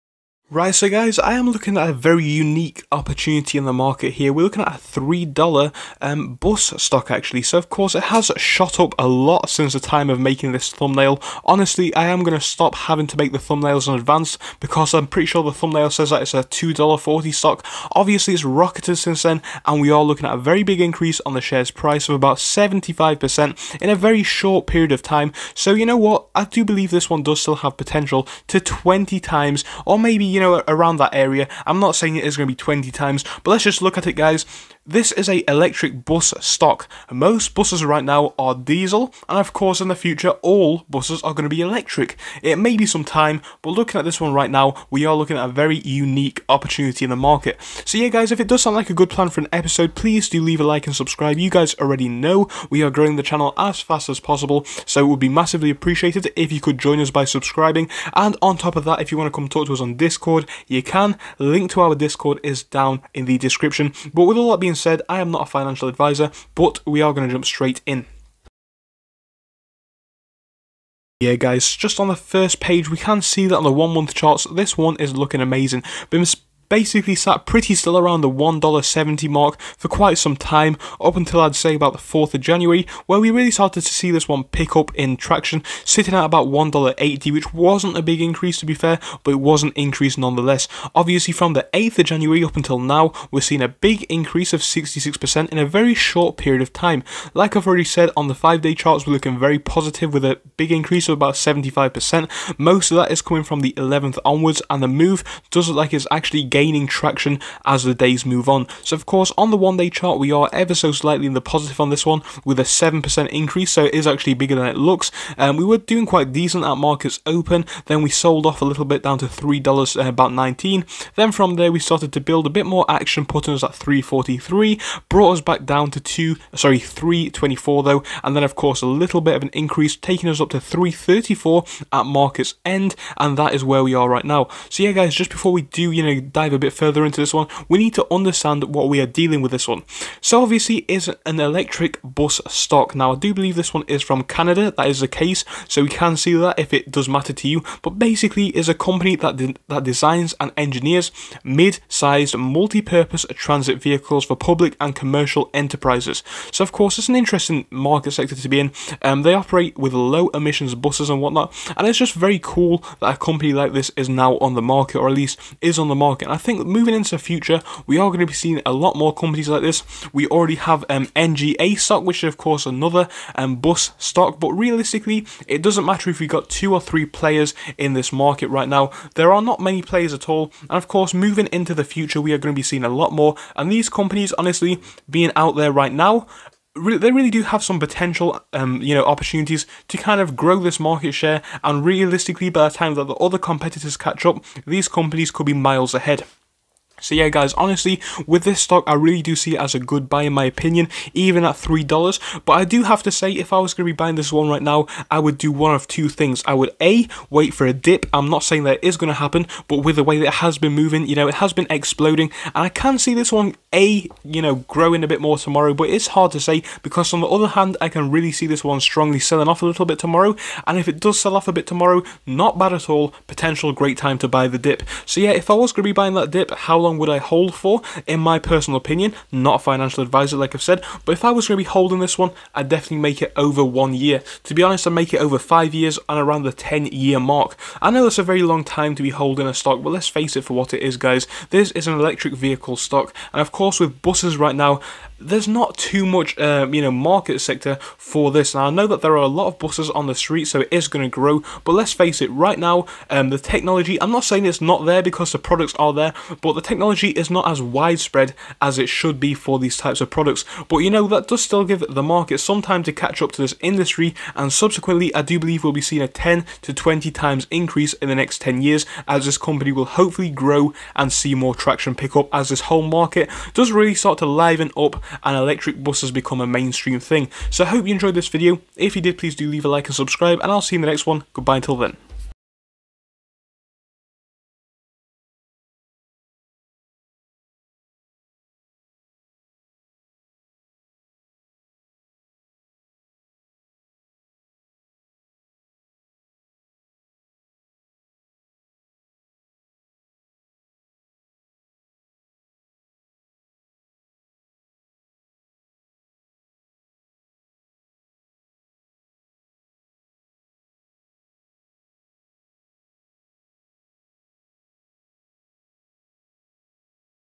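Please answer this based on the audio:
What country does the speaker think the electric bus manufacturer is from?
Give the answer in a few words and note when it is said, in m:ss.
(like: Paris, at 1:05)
Canada, at 2:24.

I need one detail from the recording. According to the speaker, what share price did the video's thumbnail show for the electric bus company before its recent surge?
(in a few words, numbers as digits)
$2.40.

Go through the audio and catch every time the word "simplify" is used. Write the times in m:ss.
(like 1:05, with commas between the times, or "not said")
not said.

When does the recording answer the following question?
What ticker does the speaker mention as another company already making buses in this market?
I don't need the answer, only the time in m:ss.
2:51.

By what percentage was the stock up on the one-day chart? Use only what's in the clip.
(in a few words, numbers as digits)
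7%.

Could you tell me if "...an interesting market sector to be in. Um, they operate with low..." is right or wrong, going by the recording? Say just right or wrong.
right.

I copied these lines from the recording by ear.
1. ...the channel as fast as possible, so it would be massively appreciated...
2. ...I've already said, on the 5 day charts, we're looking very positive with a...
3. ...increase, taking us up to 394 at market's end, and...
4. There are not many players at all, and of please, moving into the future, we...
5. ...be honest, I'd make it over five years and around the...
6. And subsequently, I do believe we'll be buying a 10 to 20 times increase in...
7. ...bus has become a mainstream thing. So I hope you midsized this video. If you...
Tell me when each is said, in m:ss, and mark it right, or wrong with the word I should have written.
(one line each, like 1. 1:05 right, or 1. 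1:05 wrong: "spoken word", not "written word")
1. 0:53 right
2. 1:37 right
3. 2:09 wrong: "334", not "394"
4. 2:59 wrong: "course", not "please"
5. 3:54 right
6. 4:24 wrong: "seeing", not "buying"
7. 4:35 wrong: "enjoyed", not "midsized".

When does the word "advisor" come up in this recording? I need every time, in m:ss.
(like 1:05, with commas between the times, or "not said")
1:05, 3:50.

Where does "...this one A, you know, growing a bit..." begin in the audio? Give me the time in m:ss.
3:33.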